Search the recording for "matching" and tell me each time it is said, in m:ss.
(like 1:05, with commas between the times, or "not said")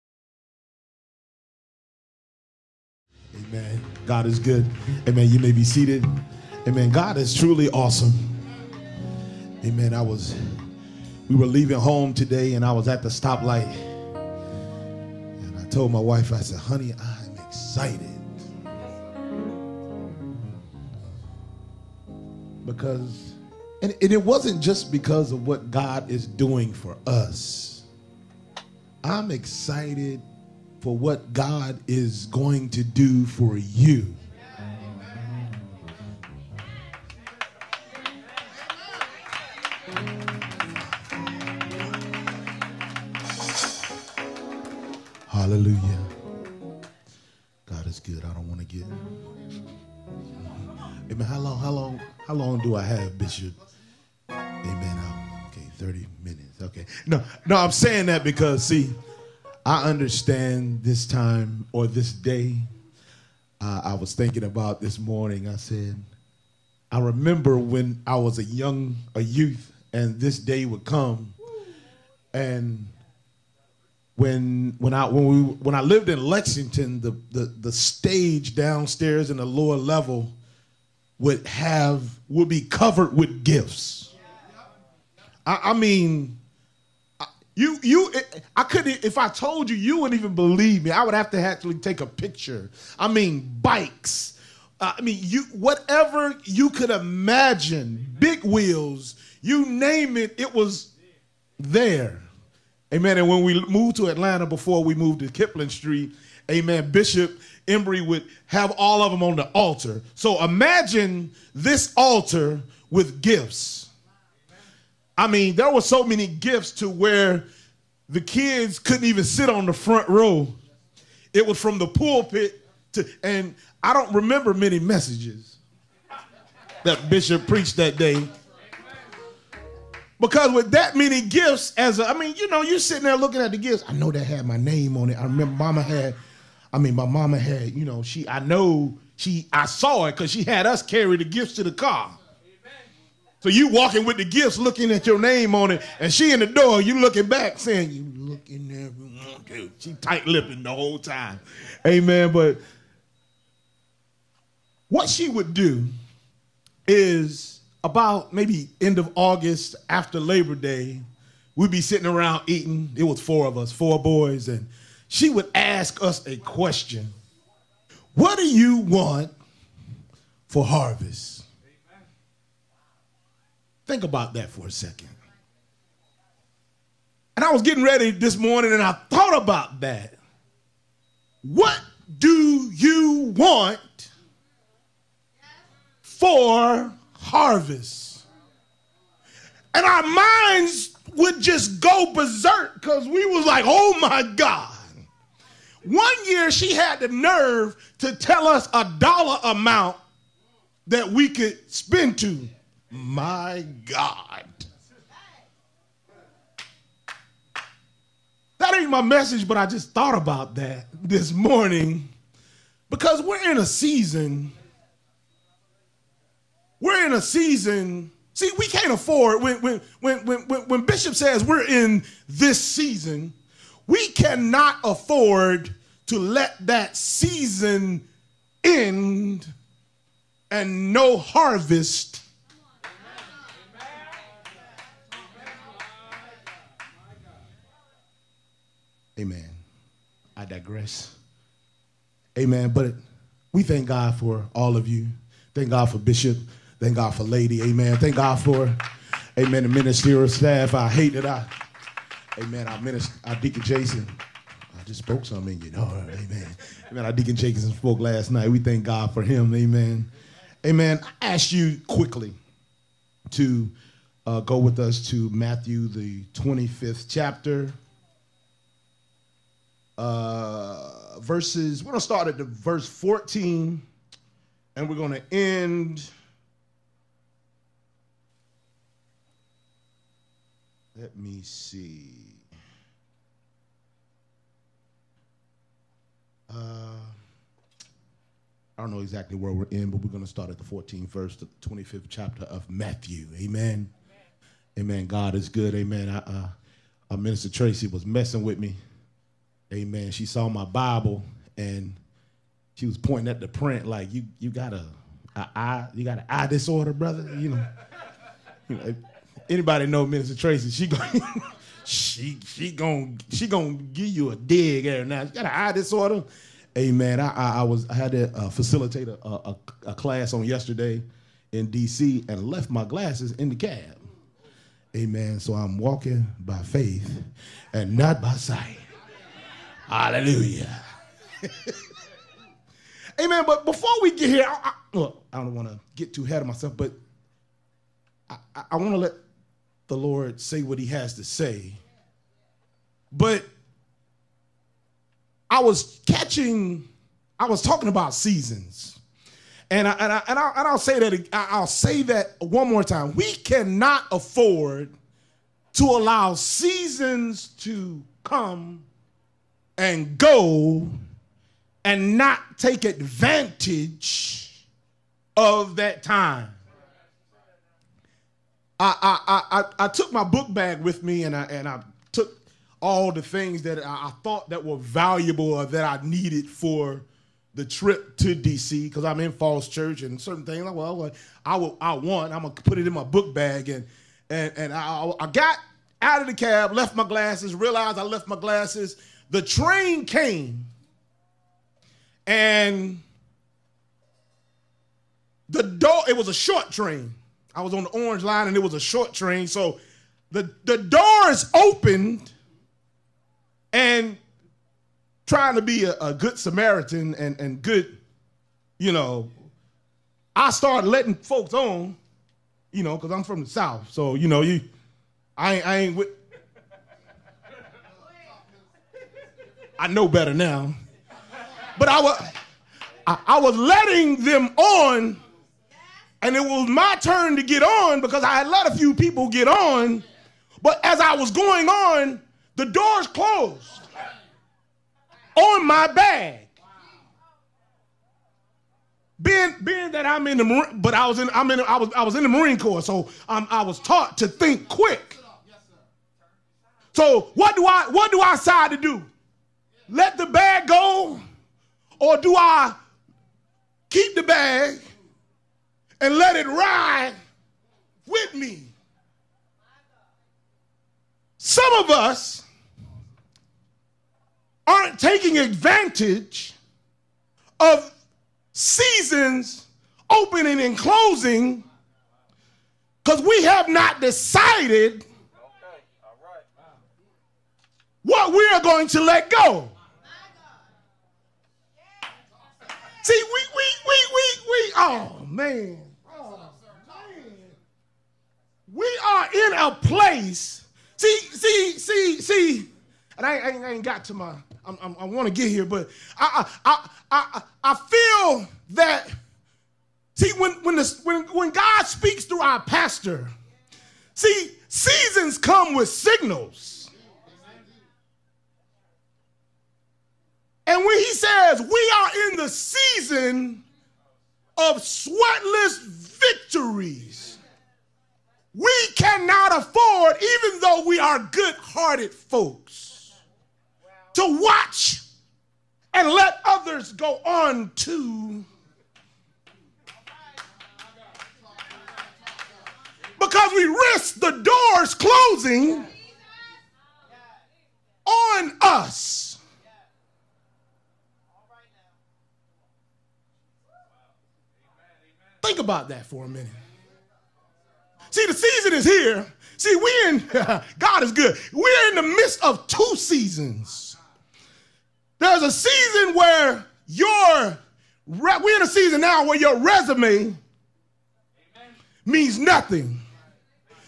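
not said.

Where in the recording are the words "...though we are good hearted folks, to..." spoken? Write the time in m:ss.
8:40.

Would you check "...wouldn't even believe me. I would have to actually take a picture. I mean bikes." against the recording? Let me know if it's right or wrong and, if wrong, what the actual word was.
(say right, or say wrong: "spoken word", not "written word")
right.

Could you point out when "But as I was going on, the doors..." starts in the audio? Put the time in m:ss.
7:10.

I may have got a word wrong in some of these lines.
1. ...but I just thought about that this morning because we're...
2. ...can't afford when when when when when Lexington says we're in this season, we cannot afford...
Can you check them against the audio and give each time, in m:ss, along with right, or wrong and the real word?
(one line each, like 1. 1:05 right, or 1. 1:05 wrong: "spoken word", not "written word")
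1. 3:29 right
2. 3:38 wrong: "Bishop", not "Lexington".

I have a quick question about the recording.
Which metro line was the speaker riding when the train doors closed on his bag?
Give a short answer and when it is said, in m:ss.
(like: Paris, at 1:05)
Orange line, at 6:37.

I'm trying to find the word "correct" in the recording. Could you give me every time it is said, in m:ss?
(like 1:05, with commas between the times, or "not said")
not said.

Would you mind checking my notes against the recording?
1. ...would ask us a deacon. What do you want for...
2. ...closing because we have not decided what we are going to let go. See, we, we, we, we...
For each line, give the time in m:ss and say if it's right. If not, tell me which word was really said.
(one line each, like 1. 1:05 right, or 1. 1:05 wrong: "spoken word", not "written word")
1. 2:45 wrong: "question", not "deacon"
2. 7:50 right.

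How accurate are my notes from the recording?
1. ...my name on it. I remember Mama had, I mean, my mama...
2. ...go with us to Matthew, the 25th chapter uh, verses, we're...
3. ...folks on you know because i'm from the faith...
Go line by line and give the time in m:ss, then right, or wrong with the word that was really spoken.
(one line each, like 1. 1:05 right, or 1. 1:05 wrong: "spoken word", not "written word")
1. 2:14 right
2. 4:24 right
3. 6:51 wrong: "south", not "faith".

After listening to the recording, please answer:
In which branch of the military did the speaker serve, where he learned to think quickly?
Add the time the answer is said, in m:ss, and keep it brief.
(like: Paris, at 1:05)
Marine Corps, at 7:22.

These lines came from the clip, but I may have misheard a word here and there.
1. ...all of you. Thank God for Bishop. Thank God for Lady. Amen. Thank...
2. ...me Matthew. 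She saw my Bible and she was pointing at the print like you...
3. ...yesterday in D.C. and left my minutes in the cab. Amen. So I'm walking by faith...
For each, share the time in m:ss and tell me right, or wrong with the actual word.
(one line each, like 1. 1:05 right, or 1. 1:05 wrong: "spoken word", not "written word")
1. 4:04 right
2. 4:58 wrong: "Amen", not "Matthew"
3. 5:20 wrong: "glasses", not "minutes".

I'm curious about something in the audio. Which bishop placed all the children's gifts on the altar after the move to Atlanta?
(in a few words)
Bishop Embry.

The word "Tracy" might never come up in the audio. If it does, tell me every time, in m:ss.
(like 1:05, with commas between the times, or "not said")
4:57, 5:10.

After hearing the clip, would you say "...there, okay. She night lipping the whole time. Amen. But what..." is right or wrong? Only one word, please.
wrong.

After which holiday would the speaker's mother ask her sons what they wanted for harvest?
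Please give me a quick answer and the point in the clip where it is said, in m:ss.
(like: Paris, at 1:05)
Labor Day, at 2:40.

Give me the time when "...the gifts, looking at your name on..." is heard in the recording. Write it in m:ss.
2:24.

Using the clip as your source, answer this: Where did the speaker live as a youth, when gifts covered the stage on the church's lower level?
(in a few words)
Lexington.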